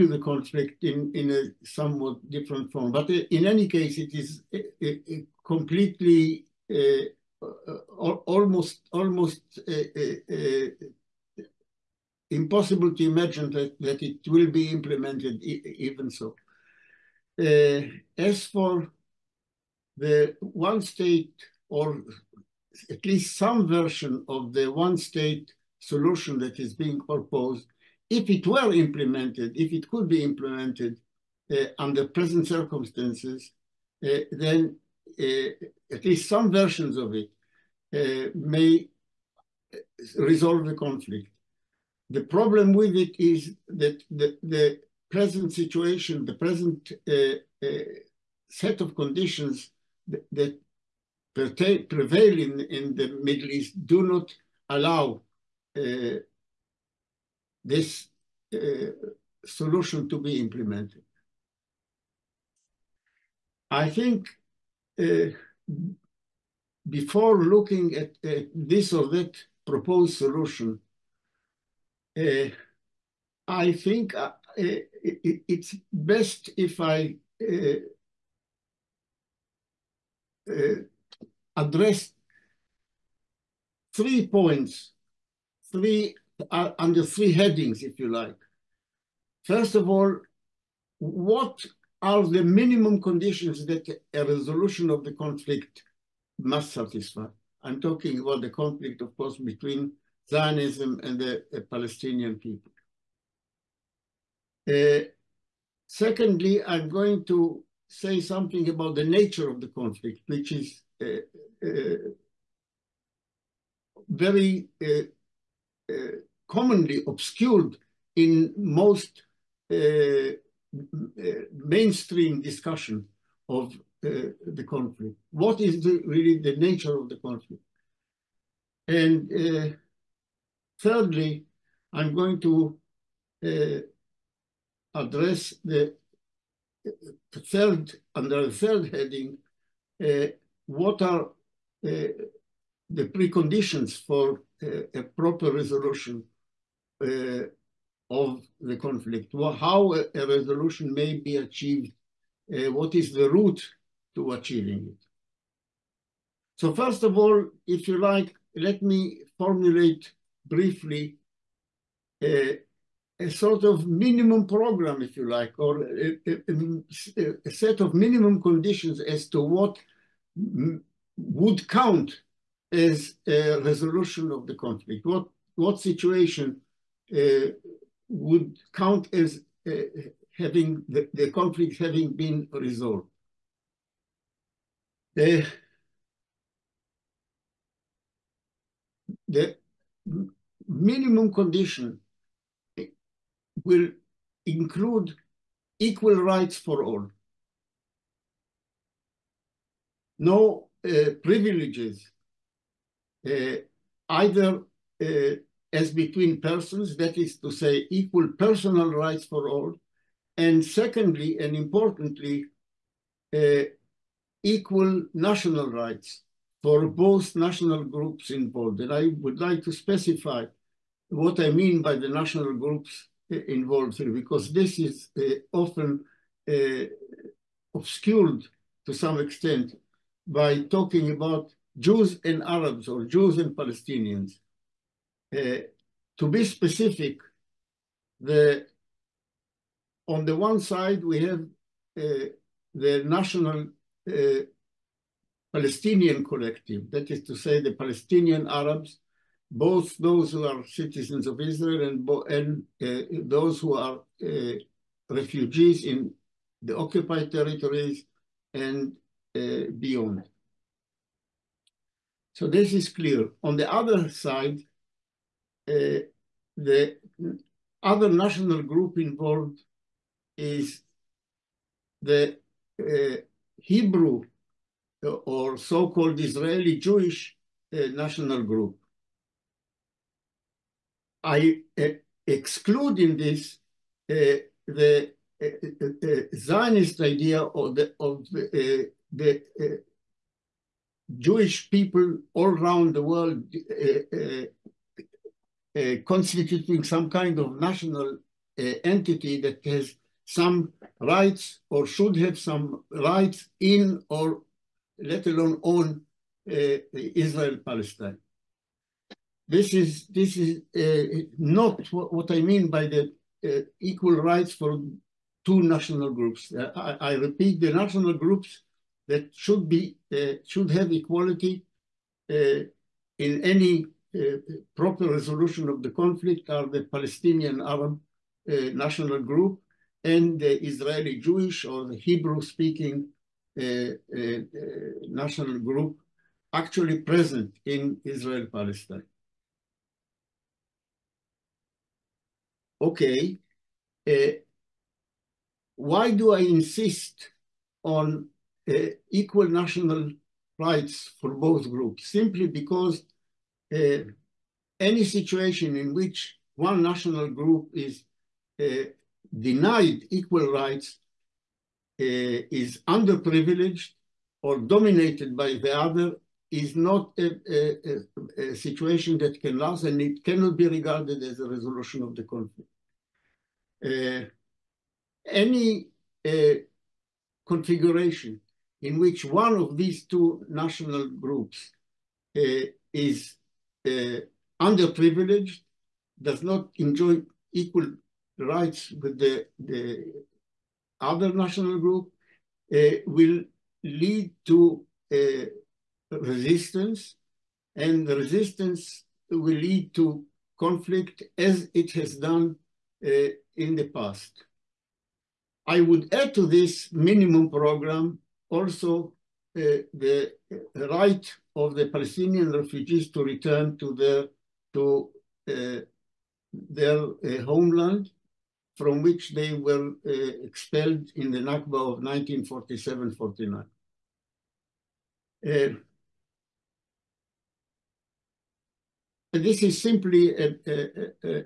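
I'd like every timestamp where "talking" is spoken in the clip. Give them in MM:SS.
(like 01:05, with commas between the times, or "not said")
01:37, 03:50.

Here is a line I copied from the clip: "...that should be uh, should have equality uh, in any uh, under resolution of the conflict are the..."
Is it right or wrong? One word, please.
wrong.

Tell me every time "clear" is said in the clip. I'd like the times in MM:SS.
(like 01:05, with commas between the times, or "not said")
04:22.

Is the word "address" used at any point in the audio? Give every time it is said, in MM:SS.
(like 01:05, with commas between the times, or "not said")
01:21, 02:14.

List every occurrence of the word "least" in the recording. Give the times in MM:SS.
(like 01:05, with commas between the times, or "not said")
00:23, 00:36.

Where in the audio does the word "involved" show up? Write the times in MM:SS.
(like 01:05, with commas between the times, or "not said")
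03:38, 03:43, 04:28.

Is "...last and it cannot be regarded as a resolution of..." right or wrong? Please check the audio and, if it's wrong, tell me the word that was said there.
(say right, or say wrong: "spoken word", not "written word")
right.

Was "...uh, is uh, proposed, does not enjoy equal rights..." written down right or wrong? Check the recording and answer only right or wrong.
wrong.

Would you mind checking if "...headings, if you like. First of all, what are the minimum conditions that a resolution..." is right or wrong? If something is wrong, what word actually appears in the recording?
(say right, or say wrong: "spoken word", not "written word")
right.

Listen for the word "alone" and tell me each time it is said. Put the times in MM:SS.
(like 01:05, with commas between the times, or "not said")
05:05.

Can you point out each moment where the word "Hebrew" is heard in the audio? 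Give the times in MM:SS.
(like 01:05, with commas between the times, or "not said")
04:33, 05:32.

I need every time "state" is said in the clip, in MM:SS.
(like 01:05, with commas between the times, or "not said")
00:20, 00:24.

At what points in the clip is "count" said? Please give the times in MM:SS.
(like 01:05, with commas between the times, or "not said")
02:51, 02:58.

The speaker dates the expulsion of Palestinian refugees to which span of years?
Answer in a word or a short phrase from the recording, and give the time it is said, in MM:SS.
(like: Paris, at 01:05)
1947-49, at 07:02.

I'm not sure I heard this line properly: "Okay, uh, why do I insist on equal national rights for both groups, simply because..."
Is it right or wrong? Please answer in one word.
right.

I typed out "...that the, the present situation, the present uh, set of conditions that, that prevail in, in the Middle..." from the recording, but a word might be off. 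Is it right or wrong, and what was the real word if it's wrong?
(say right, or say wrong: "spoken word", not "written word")
right.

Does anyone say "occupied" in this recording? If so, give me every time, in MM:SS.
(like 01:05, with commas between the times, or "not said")
04:16.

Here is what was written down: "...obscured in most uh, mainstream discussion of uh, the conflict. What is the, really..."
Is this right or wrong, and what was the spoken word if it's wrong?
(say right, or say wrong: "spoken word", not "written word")
right.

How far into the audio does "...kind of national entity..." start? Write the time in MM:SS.
04:57.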